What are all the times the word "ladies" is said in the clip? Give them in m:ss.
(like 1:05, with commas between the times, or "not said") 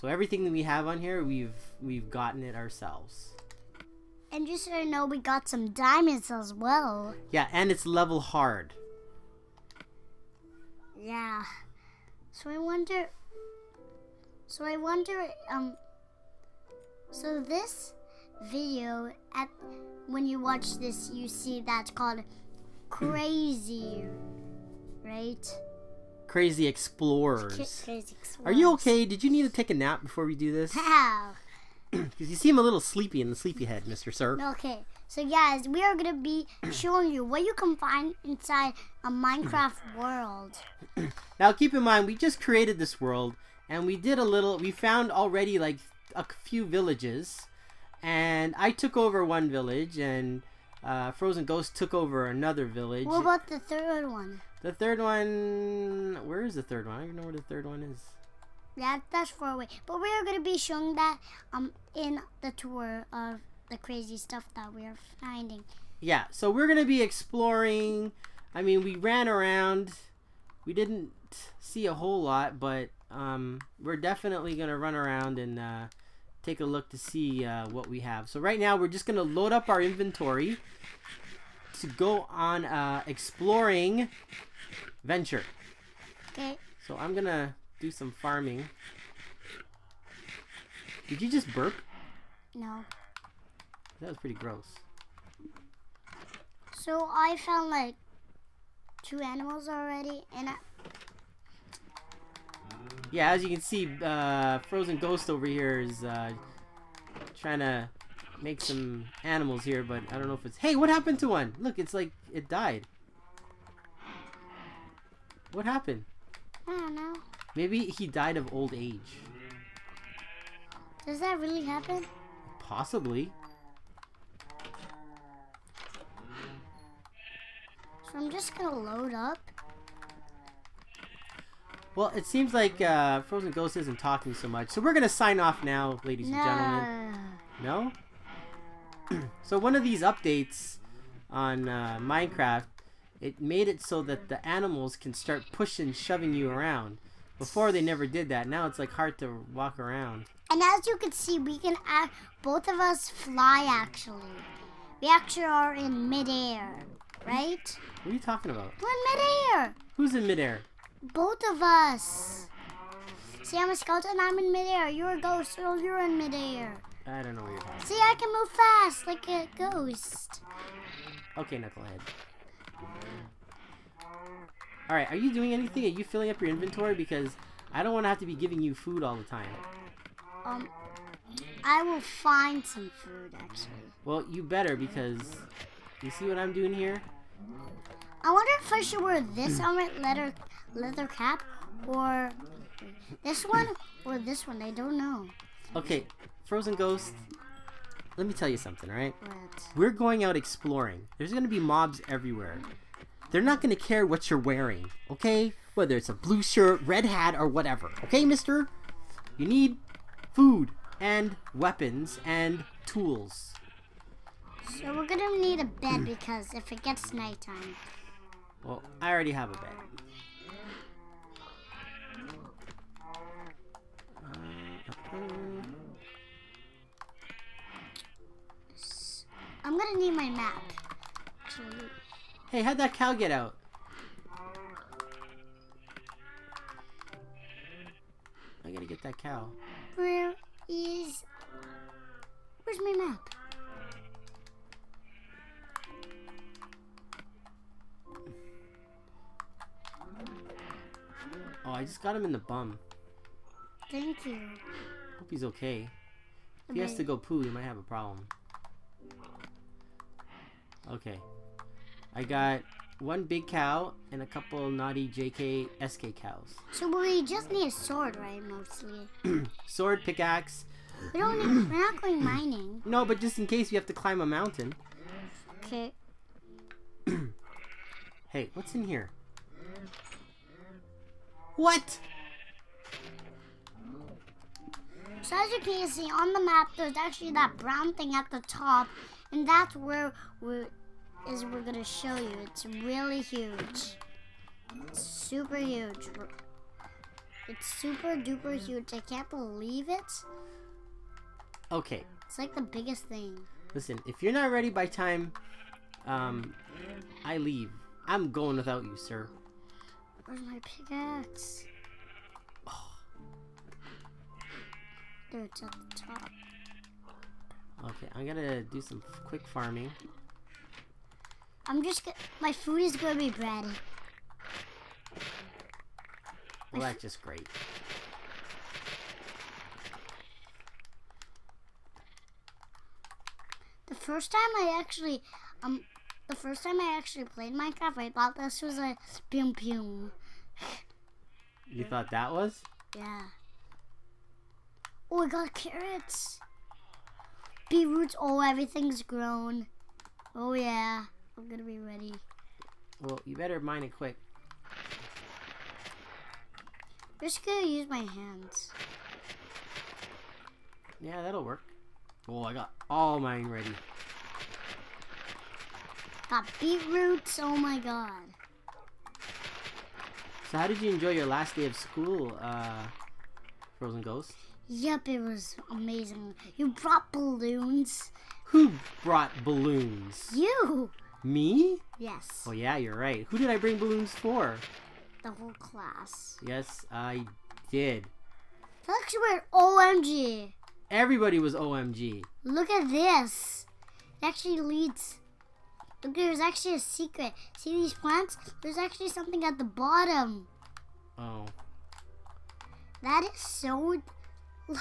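2:16.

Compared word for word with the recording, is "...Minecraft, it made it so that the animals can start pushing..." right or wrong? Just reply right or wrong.
right.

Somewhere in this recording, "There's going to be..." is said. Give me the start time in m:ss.
3:21.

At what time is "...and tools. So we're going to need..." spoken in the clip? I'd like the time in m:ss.
3:32.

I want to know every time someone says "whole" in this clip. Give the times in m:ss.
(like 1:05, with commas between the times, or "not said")
1:11, 6:25.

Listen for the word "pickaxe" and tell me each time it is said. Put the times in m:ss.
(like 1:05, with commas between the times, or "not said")
4:30, 5:10.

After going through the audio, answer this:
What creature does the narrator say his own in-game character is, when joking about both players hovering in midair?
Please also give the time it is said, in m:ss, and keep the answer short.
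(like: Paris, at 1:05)
Skeleton, at 2:43.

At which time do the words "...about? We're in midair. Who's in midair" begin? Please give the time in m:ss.
2:38.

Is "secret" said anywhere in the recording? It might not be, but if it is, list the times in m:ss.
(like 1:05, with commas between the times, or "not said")
6:36.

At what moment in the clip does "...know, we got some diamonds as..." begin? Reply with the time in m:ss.
0:04.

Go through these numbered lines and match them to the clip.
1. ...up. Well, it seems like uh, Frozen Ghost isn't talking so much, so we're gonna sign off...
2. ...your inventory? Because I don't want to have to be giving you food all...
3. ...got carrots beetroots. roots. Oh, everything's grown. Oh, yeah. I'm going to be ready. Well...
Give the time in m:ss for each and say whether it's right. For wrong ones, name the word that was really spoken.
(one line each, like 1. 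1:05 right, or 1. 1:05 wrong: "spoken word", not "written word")
1. 2:09 right
2. 2:56 right
3. 5:45 right.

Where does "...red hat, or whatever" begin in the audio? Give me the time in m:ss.
3:26.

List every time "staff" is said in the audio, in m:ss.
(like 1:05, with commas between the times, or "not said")
not said.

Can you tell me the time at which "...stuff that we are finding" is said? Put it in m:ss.
1:04.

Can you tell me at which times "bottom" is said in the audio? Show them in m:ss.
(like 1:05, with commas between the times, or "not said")
6:39.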